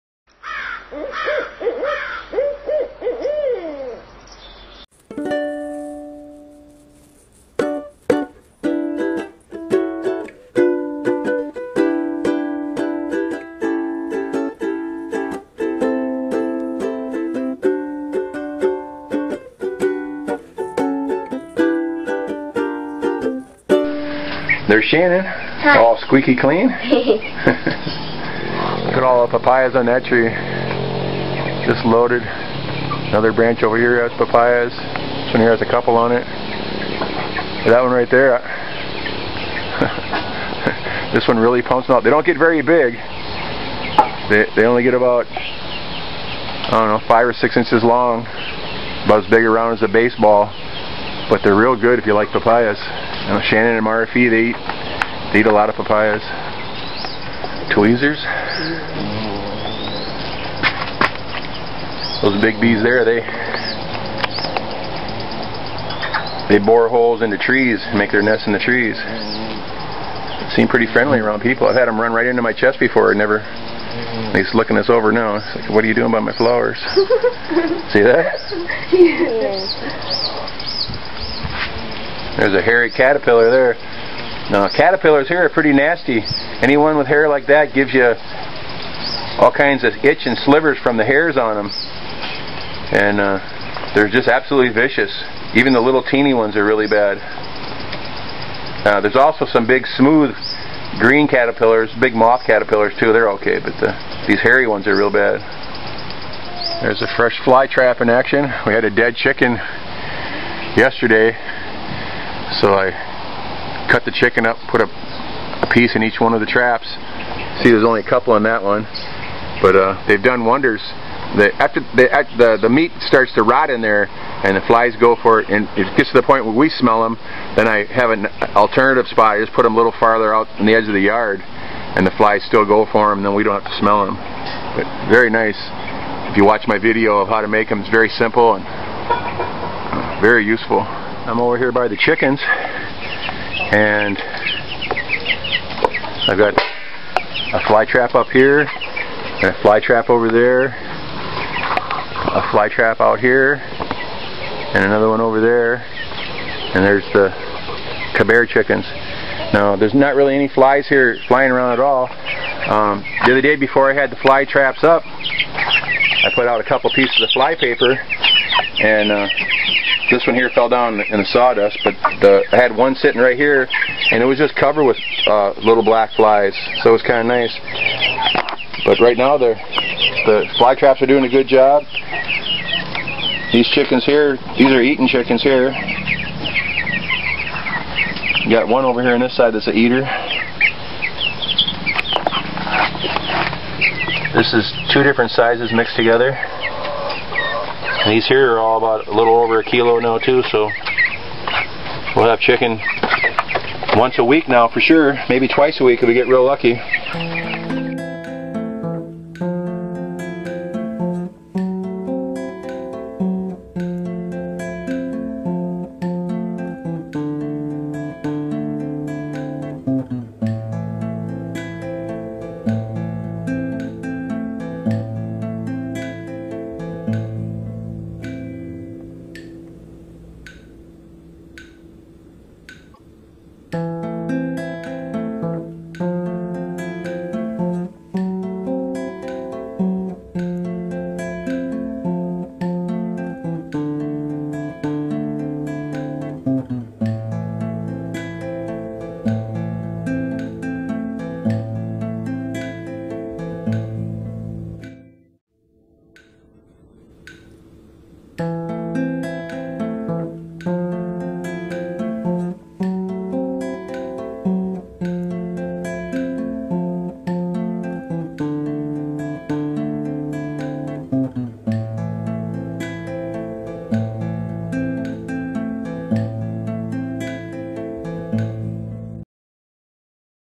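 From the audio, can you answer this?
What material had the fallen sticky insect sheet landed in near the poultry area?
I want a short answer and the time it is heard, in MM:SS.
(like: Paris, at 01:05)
Sawdust, at 02:51.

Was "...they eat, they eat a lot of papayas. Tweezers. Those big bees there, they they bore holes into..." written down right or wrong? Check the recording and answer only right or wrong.
right.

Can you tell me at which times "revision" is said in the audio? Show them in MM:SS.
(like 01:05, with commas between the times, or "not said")
not said.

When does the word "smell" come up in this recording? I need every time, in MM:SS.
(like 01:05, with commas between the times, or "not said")
02:06, 02:13.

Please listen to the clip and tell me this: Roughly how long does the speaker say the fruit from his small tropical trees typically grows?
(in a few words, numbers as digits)
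5 or 6 inches.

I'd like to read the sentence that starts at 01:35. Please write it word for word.
Even the little teeny ones are really bad.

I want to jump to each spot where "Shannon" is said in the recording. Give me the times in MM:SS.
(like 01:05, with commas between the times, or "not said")
00:24, 00:53.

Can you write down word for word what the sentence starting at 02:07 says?
Then I have an alternative spot.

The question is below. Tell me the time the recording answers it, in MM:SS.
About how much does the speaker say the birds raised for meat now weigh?
03:19.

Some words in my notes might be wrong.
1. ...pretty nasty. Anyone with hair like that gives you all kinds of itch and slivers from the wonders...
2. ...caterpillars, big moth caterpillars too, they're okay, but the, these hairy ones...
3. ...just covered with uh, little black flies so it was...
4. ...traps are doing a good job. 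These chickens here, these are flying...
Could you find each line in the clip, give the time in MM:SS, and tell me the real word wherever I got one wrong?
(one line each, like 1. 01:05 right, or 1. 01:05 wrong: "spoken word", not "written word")
1. 01:25 wrong: "hairs", not "wonders"
2. 01:41 right
3. 02:54 right
4. 03:00 wrong: "eating", not "flying".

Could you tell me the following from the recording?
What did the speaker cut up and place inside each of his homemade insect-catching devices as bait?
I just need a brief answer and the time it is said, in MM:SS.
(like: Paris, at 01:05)
Dead chicken, at 01:48.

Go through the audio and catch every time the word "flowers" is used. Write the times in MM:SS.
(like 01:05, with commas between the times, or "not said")
01:16.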